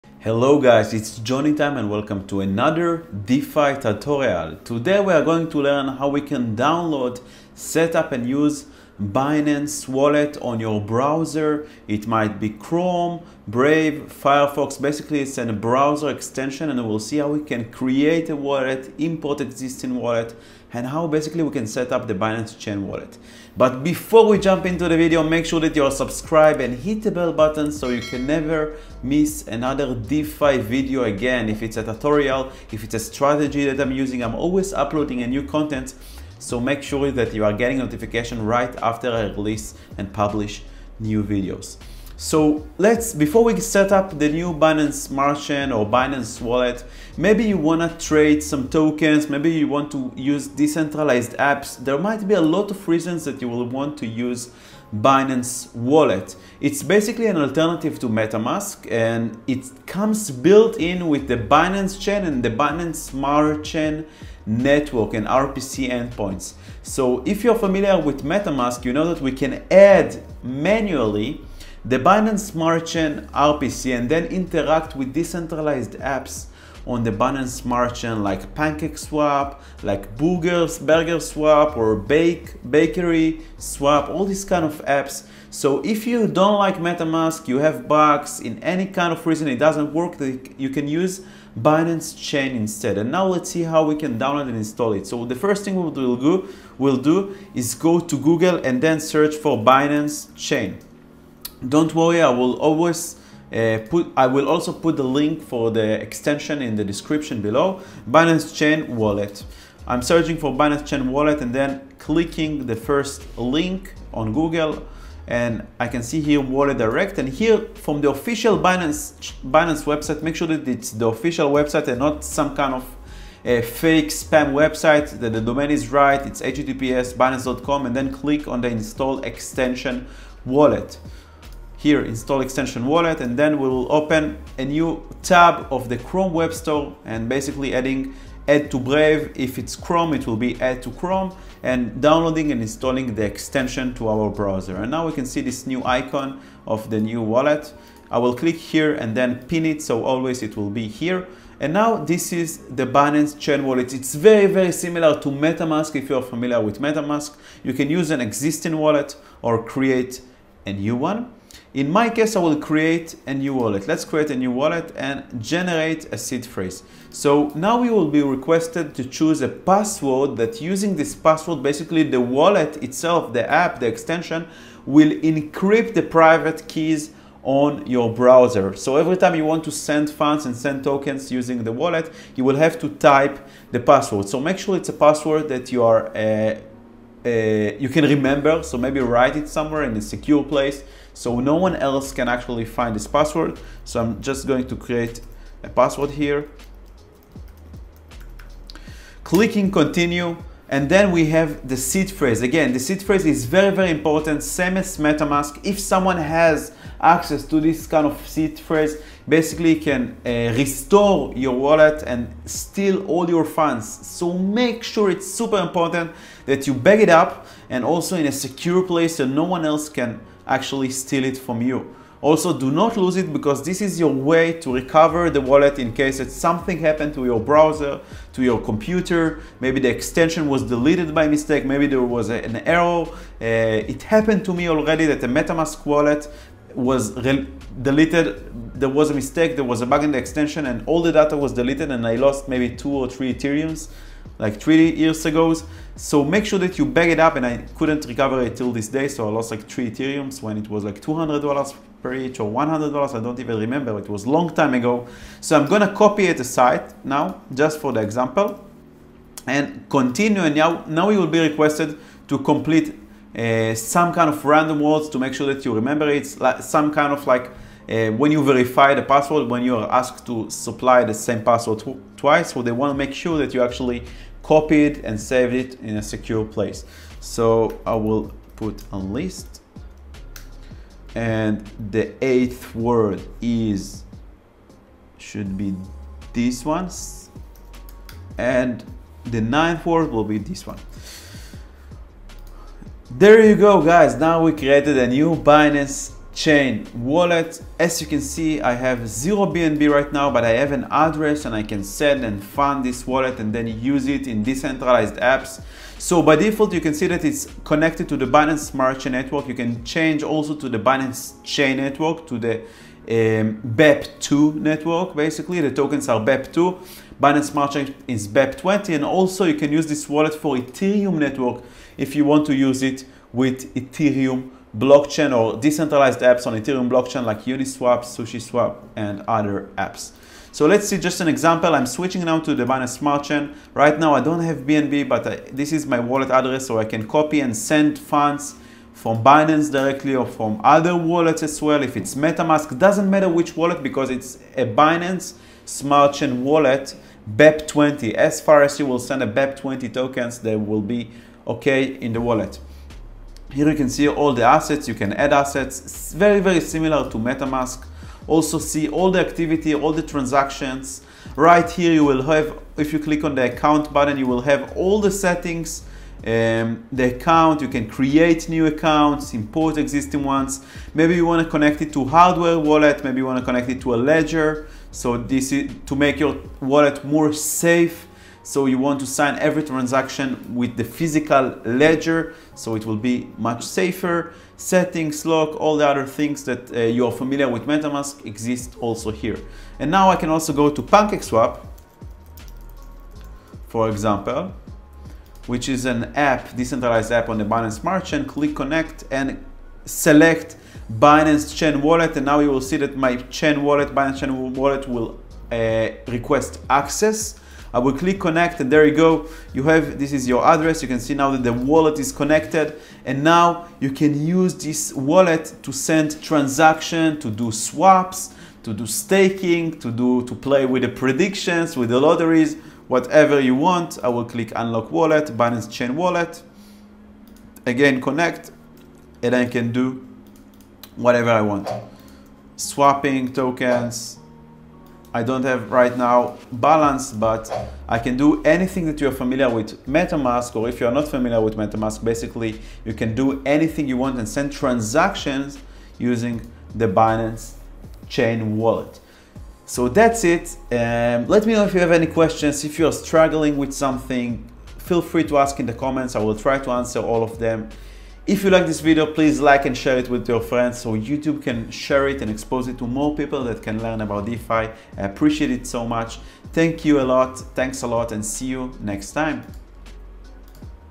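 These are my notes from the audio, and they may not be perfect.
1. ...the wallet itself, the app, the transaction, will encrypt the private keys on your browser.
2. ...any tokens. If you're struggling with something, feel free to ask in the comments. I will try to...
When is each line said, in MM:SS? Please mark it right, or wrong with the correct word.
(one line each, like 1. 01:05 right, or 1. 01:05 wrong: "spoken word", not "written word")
1. 02:52 wrong: "extension", not "transaction"
2. 07:31 wrong: "questions", not "tokens".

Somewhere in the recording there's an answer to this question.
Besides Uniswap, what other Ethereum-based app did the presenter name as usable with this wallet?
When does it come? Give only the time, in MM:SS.
05:28.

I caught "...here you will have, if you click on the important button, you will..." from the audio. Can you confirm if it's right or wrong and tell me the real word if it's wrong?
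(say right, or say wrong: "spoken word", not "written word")
wrong: "account", not "important".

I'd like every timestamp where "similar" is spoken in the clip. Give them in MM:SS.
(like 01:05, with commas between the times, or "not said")
02:34, 05:56.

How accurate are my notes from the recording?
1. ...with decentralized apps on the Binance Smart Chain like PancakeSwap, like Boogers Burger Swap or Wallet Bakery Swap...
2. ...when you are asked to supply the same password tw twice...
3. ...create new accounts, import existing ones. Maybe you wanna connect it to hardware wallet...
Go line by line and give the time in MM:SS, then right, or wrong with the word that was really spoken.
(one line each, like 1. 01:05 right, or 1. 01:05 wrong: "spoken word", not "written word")
1. 01:14 wrong: "Bake", not "Wallet"
2. 04:29 right
3. 06:07 right.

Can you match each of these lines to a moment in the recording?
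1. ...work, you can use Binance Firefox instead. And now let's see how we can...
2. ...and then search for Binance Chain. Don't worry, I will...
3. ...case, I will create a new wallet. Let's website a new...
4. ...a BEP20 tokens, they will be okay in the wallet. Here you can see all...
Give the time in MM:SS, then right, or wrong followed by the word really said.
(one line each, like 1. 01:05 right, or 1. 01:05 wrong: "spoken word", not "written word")
1. 01:29 wrong: "Chain", not "Firefox"
2. 01:38 right
3. 02:42 wrong: "create", not "website"
4. 05:49 right.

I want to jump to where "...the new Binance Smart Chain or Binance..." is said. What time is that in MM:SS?
00:44.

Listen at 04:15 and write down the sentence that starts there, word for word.
So I'm going to copy it aside now just for the example and continue.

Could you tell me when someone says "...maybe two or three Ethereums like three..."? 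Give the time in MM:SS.
04:02.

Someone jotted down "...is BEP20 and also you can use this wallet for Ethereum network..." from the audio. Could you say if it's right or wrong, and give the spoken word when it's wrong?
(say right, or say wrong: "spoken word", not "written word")
right.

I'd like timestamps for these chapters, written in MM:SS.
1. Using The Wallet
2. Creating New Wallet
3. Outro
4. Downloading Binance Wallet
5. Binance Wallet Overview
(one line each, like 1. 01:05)
1. 05:20
2. 02:42
3. 07:20
4. 01:30
5. 02:25.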